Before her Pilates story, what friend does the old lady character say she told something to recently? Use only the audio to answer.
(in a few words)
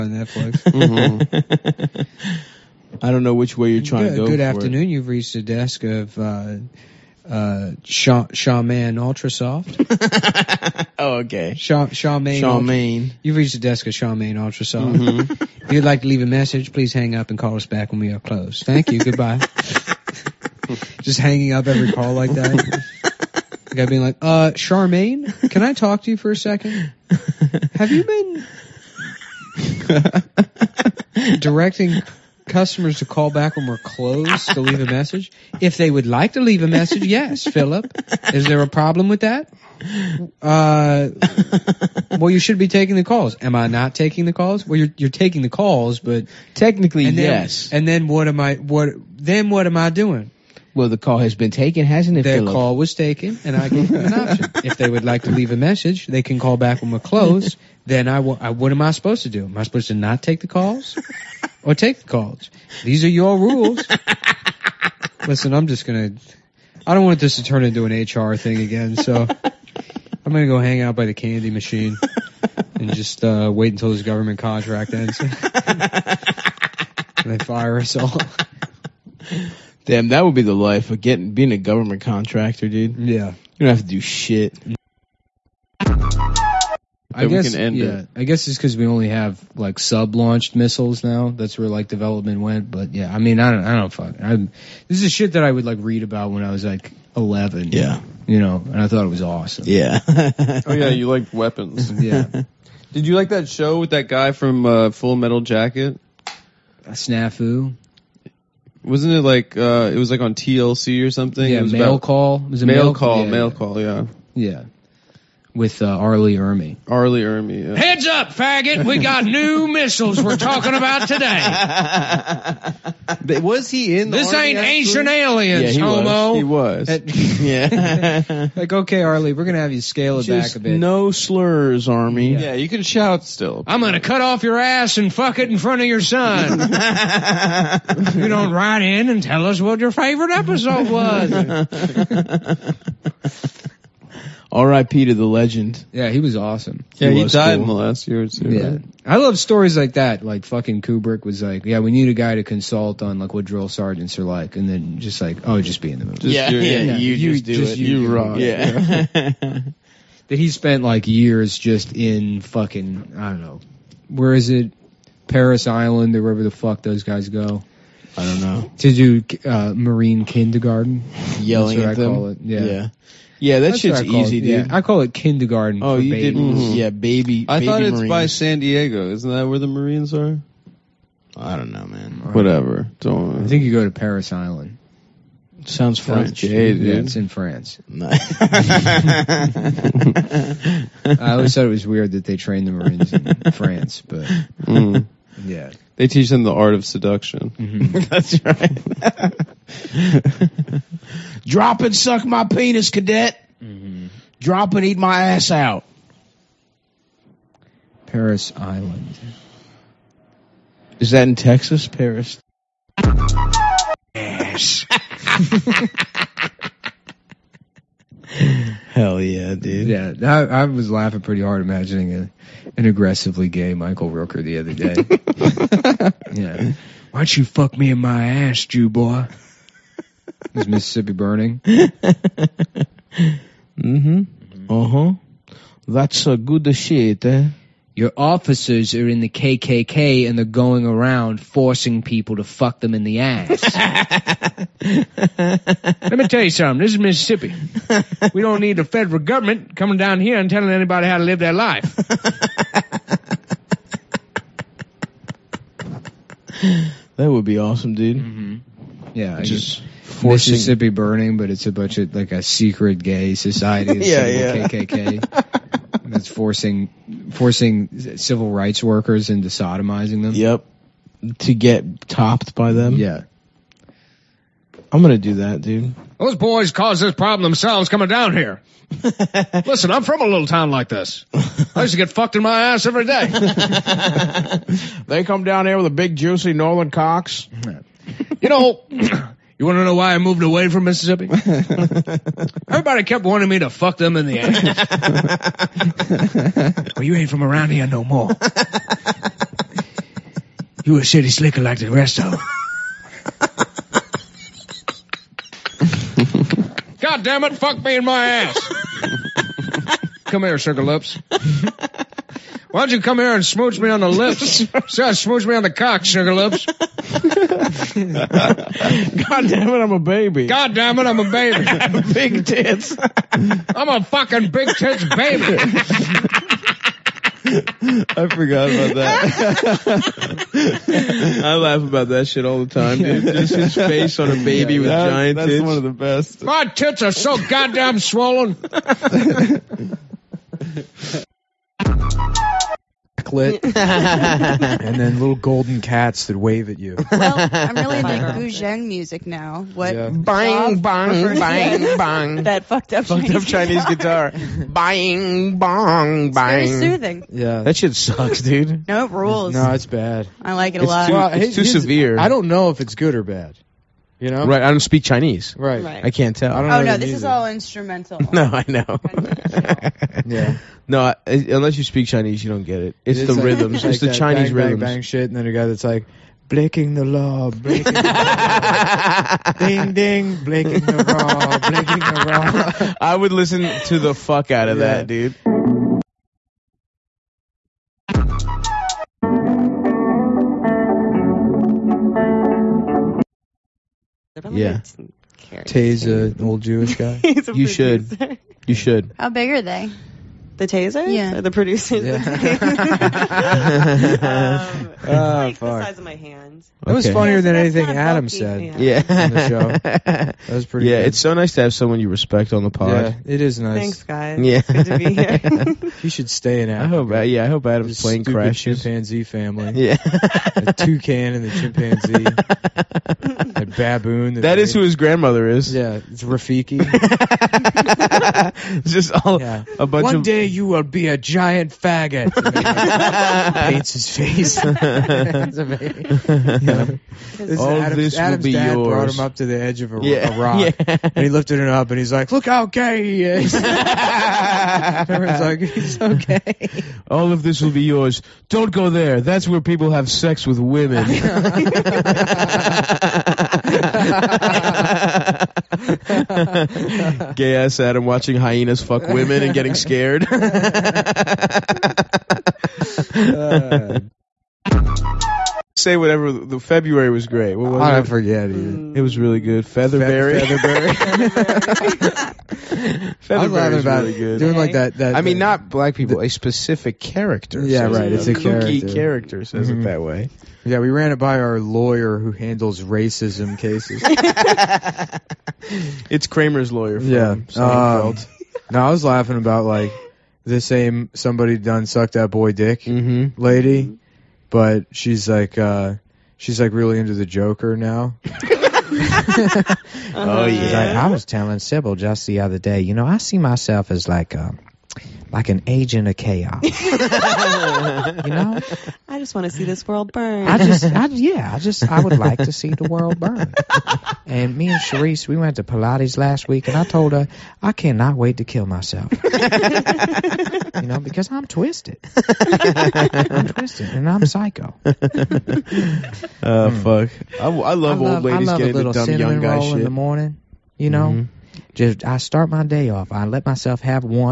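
Sybil.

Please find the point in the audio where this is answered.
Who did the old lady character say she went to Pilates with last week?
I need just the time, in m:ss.
8:34.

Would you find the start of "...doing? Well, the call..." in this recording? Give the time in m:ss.
0:49.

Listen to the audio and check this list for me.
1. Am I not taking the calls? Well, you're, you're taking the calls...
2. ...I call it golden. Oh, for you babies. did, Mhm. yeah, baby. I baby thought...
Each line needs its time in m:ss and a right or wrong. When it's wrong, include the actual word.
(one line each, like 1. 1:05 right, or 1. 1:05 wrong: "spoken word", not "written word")
1. 0:43 right
2. 2:54 wrong: "kindergarten", not "golden".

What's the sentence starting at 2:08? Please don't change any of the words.
like okay, Arlie, we're gonna have you scale it Just back a bit.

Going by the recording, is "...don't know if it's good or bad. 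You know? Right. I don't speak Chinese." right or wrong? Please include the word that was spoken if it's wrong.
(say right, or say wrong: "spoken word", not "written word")
right.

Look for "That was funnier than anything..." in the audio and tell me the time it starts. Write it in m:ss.
6:46.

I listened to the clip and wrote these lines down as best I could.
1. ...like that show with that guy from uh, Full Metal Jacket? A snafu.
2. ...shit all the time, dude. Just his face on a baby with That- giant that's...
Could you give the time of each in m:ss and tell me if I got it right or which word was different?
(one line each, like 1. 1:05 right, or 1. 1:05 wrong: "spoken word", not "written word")
1. 1:43 right
2. 5:32 right.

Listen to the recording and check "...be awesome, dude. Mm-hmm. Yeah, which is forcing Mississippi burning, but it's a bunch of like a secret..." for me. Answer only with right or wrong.
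right.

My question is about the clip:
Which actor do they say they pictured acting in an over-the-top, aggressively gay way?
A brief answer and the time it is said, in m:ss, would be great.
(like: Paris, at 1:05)
Michael Rooker, at 3:43.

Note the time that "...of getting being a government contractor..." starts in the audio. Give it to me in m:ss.
1:20.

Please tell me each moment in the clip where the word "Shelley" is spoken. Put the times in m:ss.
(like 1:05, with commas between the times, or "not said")
not said.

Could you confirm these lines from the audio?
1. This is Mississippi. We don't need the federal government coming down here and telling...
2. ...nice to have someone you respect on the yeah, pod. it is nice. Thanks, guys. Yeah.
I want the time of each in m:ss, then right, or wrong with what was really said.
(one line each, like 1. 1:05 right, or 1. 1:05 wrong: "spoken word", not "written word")
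1. 4:06 right
2. 6:51 right.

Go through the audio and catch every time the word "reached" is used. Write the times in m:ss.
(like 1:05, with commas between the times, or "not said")
0:05, 0:13.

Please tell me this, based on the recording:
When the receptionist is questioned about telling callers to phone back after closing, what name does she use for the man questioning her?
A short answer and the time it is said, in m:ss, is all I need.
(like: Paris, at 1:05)
Philip, at 0:37.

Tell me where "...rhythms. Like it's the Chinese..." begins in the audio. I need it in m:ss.
6:13.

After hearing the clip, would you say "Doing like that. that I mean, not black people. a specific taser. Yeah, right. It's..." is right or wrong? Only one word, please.
wrong.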